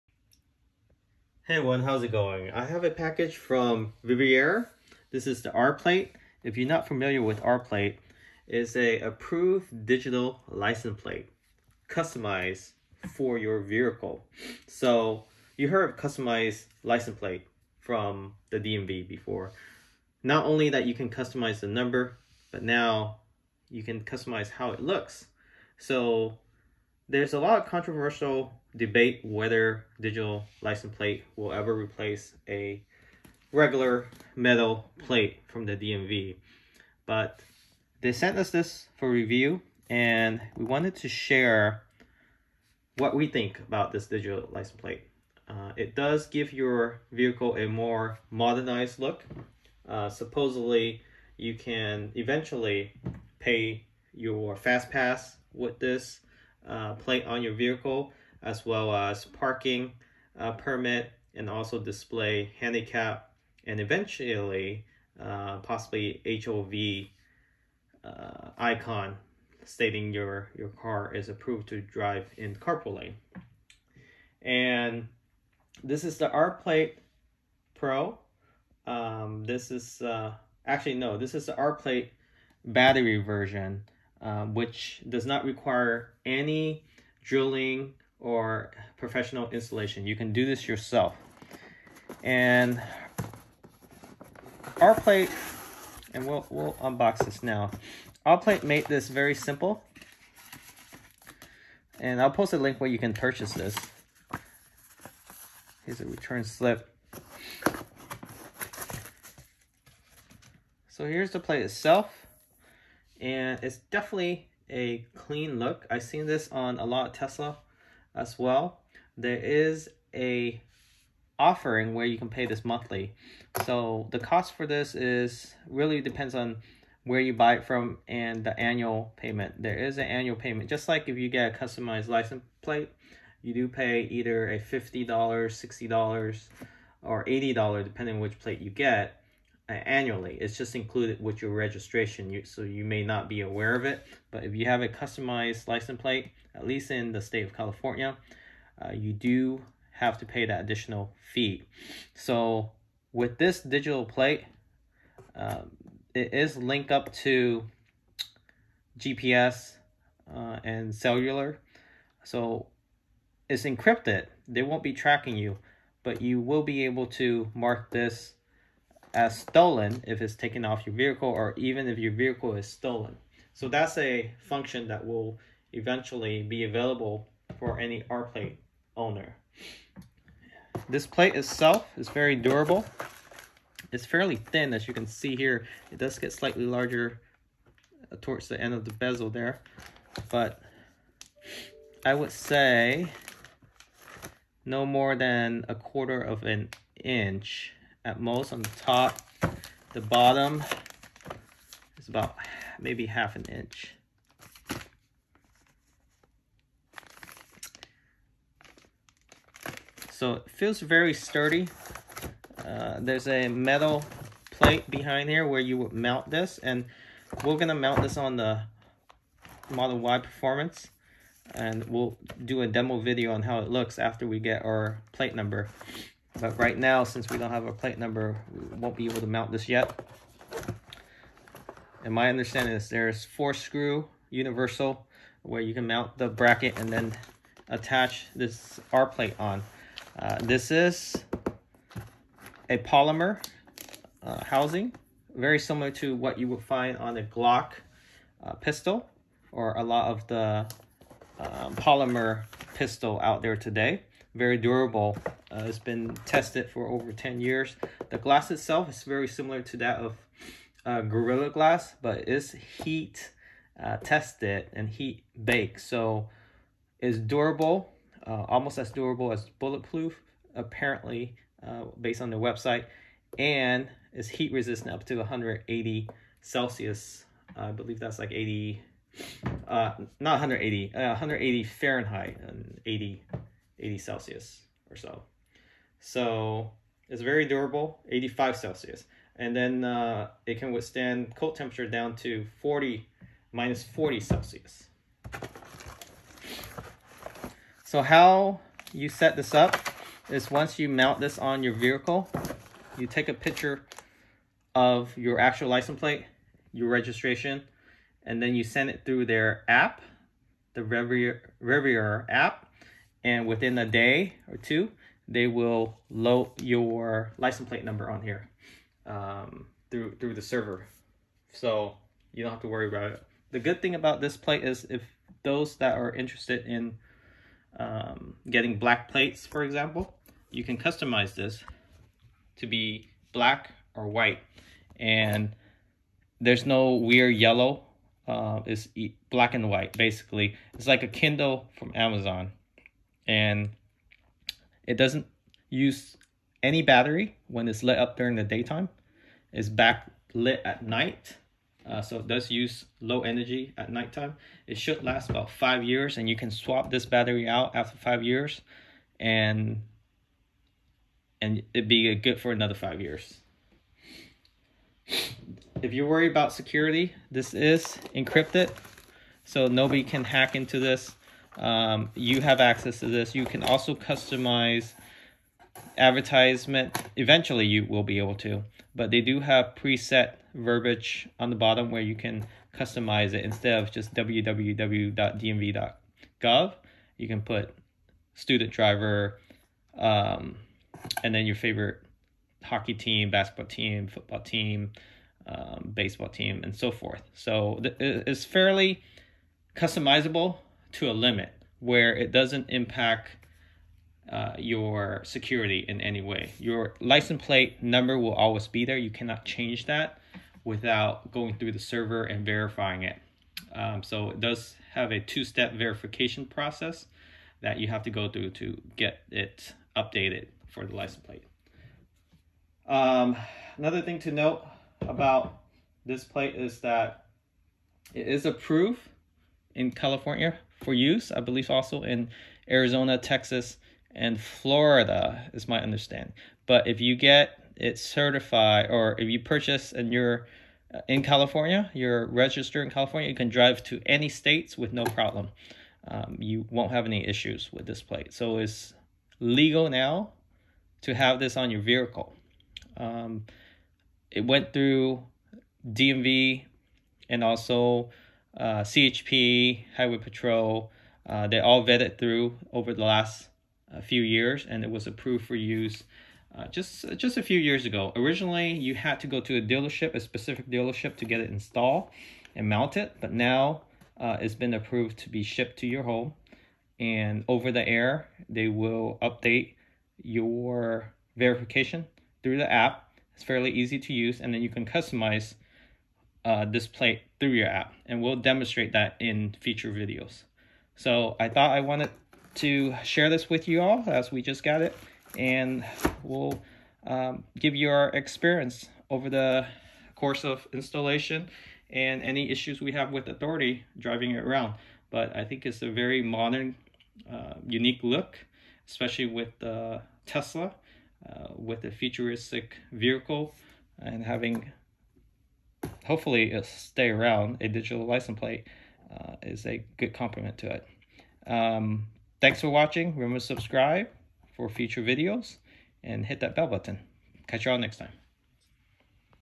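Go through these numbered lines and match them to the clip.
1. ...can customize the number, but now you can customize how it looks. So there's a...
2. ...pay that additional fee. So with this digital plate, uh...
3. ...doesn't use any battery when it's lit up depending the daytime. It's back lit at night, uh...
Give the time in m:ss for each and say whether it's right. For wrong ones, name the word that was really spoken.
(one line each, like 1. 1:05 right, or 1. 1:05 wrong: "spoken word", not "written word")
1. 0:20 right
2. 2:30 right
3. 5:44 wrong: "during", not "depending".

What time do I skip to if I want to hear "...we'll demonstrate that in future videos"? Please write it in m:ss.
8:08.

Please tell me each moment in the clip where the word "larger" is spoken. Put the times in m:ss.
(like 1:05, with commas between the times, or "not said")
3:06.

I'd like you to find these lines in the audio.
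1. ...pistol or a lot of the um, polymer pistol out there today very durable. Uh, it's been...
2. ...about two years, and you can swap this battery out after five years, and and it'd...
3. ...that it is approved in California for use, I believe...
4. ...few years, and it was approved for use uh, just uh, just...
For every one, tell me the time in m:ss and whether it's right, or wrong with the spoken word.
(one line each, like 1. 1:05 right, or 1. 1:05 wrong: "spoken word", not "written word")
1. 4:08 right
2. 5:55 wrong: "five", not "two"
3. 7:06 right
4. 7:44 right.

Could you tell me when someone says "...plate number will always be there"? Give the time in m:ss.
6:47.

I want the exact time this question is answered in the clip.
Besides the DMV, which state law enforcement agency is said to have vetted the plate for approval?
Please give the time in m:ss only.
7:38.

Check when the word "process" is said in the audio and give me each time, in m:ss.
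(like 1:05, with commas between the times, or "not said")
6:56.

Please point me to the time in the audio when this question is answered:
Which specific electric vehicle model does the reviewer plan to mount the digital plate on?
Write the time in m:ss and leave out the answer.
3:39.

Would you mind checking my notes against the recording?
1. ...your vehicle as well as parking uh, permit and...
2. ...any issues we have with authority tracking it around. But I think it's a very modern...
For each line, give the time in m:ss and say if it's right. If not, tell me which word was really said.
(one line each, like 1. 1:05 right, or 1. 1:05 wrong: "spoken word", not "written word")
1. 0:57 right
2. 8:22 wrong: "driving", not "tracking".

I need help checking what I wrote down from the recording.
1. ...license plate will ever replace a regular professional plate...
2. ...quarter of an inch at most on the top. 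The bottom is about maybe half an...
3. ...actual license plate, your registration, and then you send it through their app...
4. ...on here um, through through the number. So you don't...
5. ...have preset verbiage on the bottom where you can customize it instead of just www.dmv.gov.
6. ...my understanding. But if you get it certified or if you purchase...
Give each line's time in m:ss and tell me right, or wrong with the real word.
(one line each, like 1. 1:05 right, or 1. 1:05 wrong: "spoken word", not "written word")
1. 0:30 wrong: "metal", not "professional"
2. 3:15 right
3. 5:05 right
4. 5:18 wrong: "server", not "number"
5. 6:19 right
6. 7:15 right.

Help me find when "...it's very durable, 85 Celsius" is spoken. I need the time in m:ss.
4:47.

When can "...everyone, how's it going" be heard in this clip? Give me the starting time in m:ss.
0:01.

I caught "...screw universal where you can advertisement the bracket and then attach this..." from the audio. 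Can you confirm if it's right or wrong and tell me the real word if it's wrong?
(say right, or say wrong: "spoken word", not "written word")
wrong: "mount", not "advertisement".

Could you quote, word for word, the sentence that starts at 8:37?
A digital license plate uh, is a good complement to it.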